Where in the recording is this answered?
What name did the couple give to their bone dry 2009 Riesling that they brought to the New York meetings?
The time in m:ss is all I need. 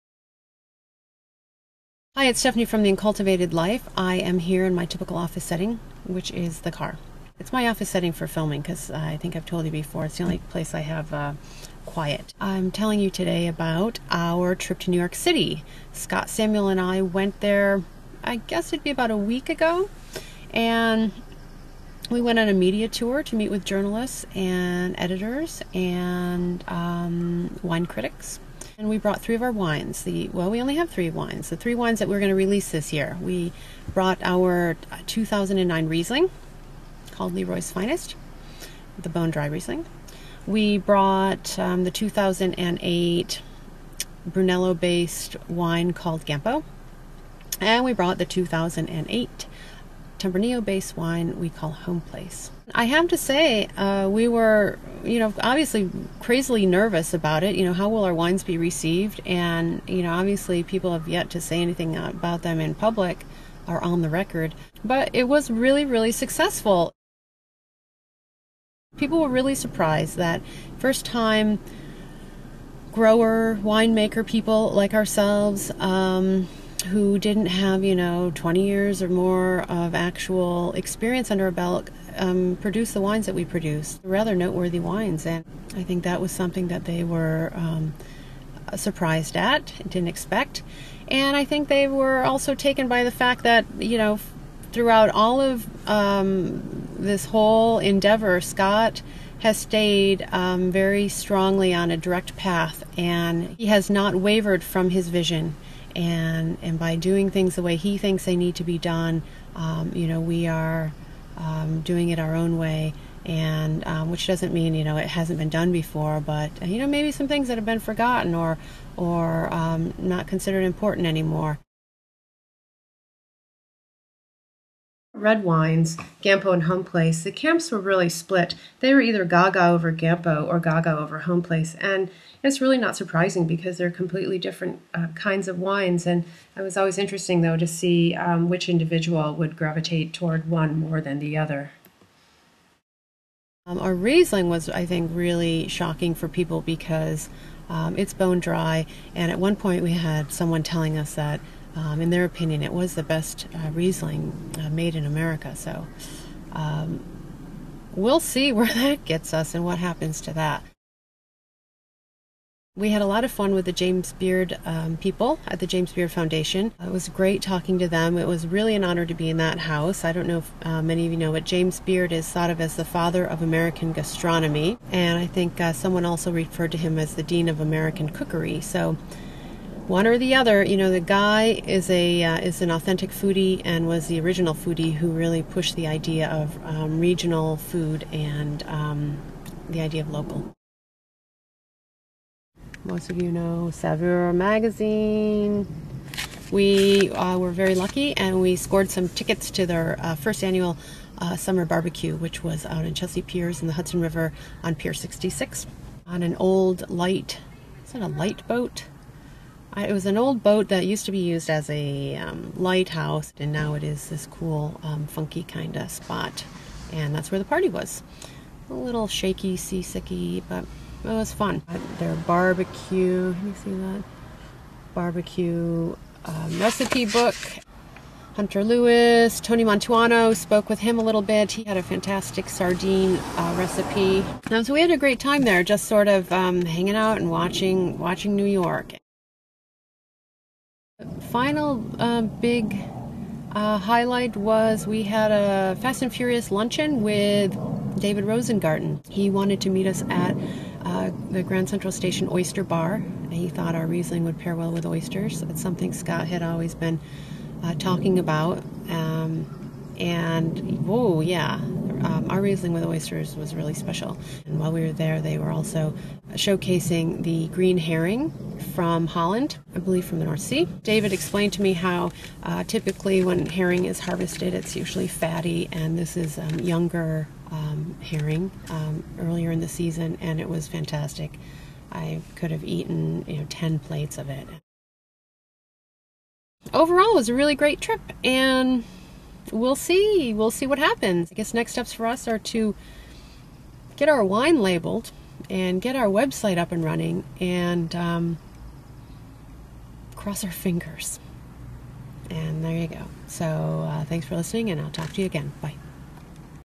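0:37.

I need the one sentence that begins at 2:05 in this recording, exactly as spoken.
red wines, Gampo and Home Place, the camps were really split.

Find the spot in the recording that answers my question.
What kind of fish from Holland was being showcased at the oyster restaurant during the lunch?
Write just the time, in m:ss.
4:27.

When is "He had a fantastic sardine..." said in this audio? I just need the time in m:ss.
3:51.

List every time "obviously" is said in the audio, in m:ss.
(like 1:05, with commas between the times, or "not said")
0:55, 1:00.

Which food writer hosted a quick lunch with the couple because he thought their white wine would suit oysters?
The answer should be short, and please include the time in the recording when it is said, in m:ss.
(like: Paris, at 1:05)
David Rosengarten, at 4:07.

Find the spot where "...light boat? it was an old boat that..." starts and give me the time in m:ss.
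3:28.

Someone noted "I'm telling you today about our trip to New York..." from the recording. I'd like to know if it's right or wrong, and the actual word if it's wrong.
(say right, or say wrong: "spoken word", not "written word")
right.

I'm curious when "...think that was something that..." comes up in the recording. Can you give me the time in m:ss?
1:25.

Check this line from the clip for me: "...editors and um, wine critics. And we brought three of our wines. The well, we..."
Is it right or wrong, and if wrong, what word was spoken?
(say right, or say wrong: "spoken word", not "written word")
right.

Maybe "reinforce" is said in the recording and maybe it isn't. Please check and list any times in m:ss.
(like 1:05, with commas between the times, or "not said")
not said.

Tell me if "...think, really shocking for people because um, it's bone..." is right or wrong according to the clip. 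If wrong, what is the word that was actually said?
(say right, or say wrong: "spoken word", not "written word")
right.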